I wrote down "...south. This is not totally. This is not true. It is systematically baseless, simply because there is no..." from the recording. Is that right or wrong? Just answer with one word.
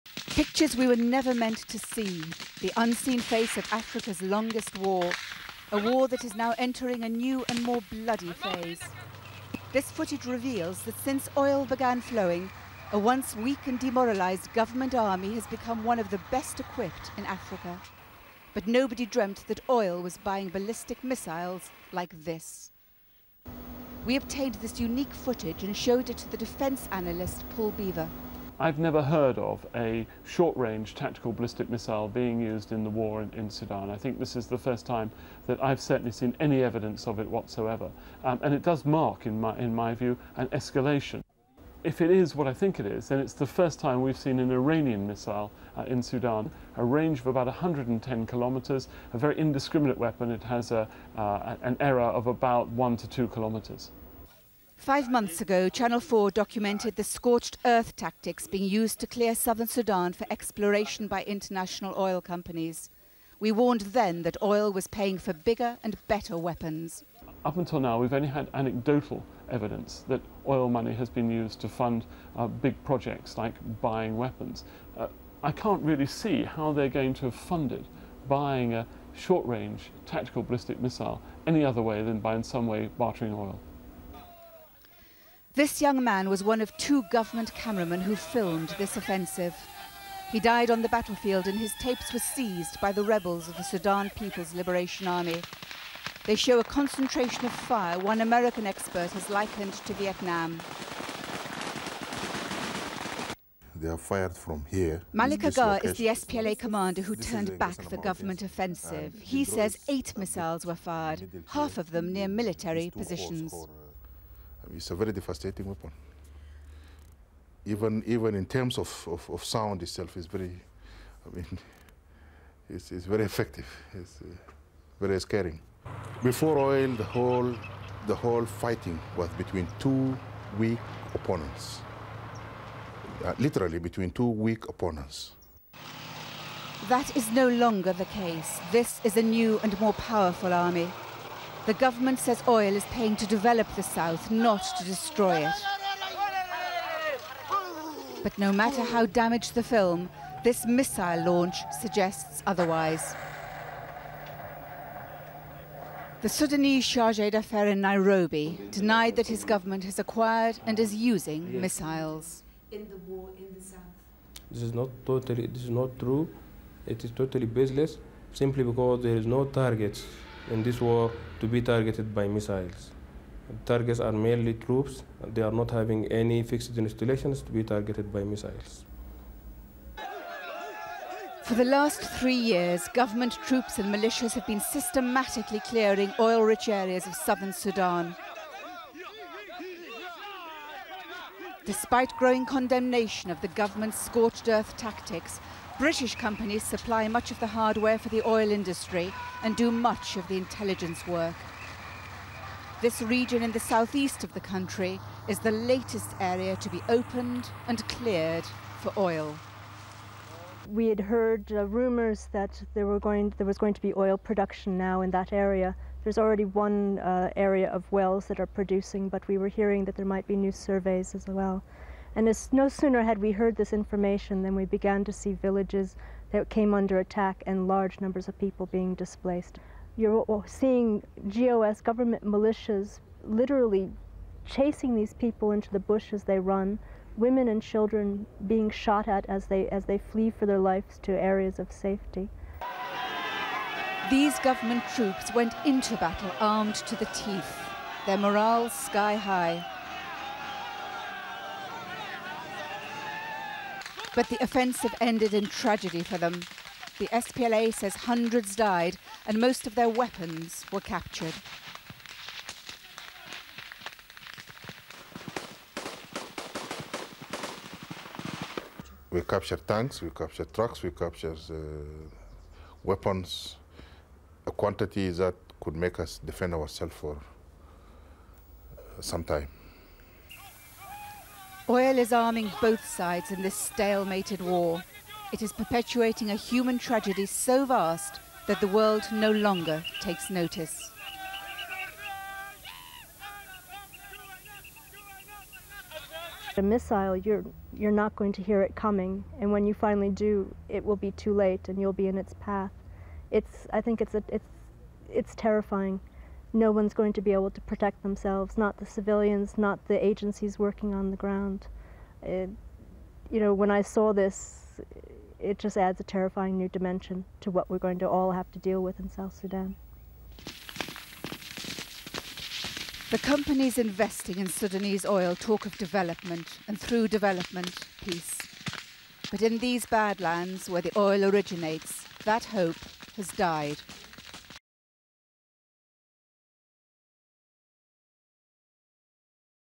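wrong.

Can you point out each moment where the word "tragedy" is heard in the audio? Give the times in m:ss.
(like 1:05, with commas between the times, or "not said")
4:15, 4:46.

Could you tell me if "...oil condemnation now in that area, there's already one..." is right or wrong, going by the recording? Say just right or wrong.
wrong.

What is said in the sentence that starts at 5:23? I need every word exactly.
The companies investing in Sudanese oil talk of development, and through development, peace.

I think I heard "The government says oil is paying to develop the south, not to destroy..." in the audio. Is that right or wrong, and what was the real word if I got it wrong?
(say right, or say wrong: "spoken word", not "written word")
right.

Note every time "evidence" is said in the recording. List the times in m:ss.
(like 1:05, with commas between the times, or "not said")
0:36, 1:09.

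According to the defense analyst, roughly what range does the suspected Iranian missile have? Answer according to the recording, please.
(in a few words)
110 kilometers.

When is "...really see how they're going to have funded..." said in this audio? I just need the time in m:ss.
1:15.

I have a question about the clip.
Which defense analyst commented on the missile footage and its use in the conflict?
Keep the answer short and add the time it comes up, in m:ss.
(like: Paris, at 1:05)
Paul Beaver, at 0:27.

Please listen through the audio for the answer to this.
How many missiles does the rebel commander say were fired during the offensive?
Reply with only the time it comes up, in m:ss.
1:49.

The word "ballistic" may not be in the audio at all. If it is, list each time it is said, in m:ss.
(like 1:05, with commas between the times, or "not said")
0:20, 0:31, 1:20.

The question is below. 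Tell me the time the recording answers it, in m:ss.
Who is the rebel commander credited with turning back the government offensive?
1:45.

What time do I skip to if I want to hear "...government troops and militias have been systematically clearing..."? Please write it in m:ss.
3:02.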